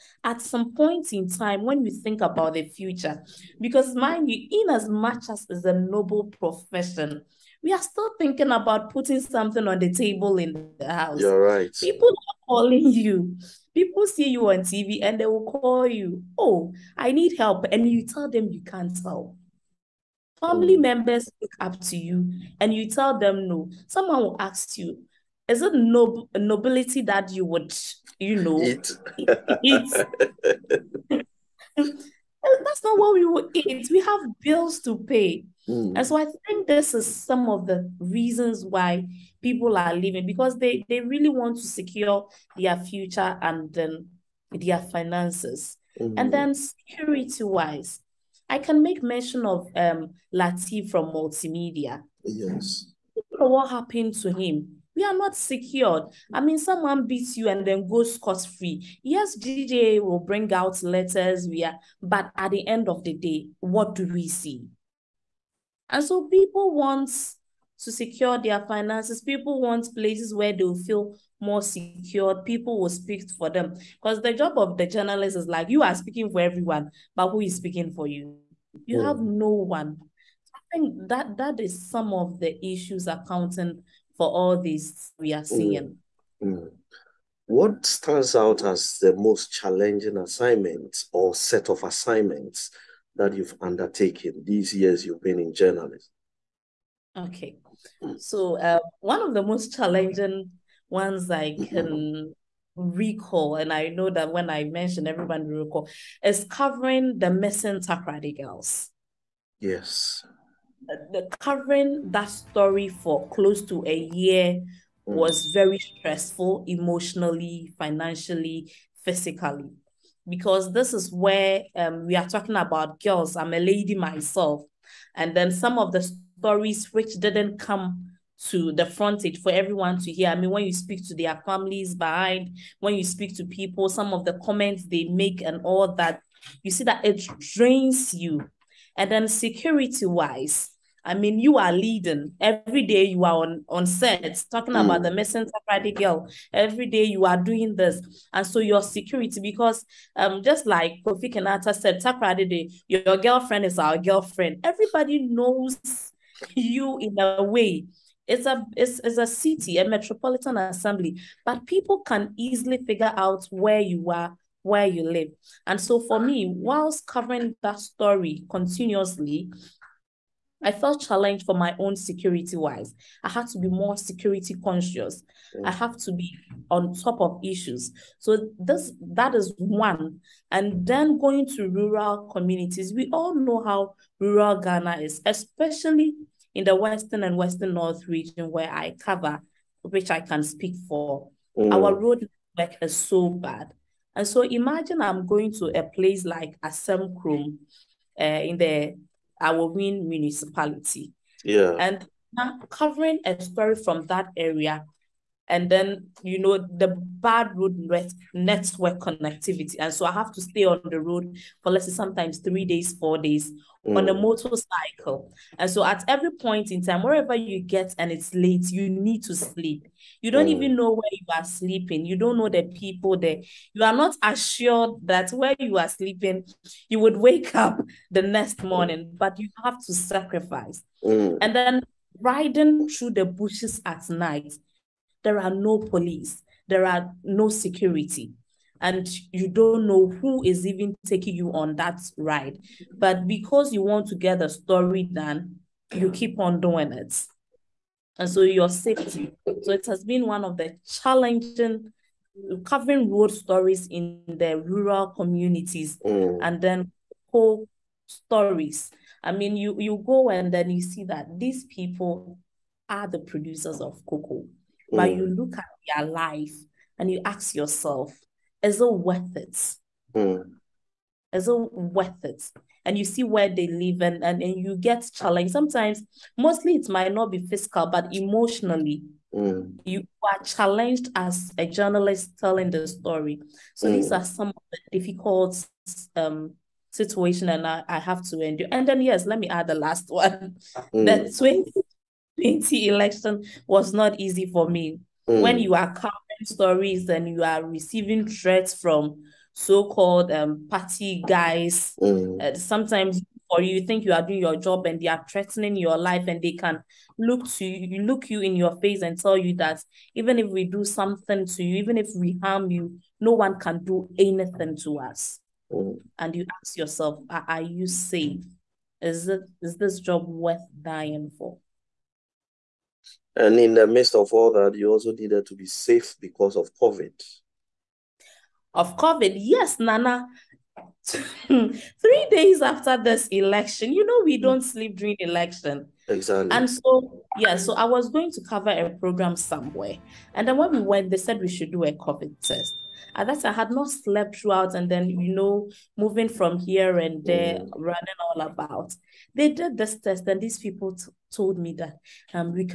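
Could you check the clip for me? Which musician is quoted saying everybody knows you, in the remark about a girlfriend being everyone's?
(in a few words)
Kofi Kinaata.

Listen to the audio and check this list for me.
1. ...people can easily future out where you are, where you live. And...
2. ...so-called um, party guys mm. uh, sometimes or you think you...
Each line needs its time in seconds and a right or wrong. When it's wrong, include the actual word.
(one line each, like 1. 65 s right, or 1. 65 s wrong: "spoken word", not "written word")
1. 161 s wrong: "figure", not "future"
2. 299 s right.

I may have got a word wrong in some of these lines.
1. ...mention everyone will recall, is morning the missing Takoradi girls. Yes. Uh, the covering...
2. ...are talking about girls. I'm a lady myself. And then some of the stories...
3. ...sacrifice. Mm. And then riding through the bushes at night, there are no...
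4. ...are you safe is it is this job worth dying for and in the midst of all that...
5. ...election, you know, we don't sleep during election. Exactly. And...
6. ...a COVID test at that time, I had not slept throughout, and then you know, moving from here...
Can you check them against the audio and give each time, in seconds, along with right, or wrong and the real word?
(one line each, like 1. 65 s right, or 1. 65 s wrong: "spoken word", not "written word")
1. 104 s wrong: "covering", not "morning"
2. 122 s right
3. 229 s right
4. 317 s right
5. 333 s right
6. 341 s right.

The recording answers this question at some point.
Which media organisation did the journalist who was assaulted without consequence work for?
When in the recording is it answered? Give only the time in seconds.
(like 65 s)
51 s.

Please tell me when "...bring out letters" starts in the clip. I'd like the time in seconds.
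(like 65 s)
60 s.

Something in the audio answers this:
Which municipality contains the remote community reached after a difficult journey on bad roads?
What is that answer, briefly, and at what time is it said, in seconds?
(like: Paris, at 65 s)
Aowin municipality, at 199 s.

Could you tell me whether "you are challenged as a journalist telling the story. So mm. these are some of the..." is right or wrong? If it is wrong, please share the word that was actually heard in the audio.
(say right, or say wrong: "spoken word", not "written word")
right.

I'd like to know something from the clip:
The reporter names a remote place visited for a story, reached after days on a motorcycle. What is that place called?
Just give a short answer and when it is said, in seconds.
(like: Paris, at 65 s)
Asemkrum, at 196 s.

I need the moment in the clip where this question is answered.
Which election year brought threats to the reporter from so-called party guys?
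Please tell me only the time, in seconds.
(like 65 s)
291 s.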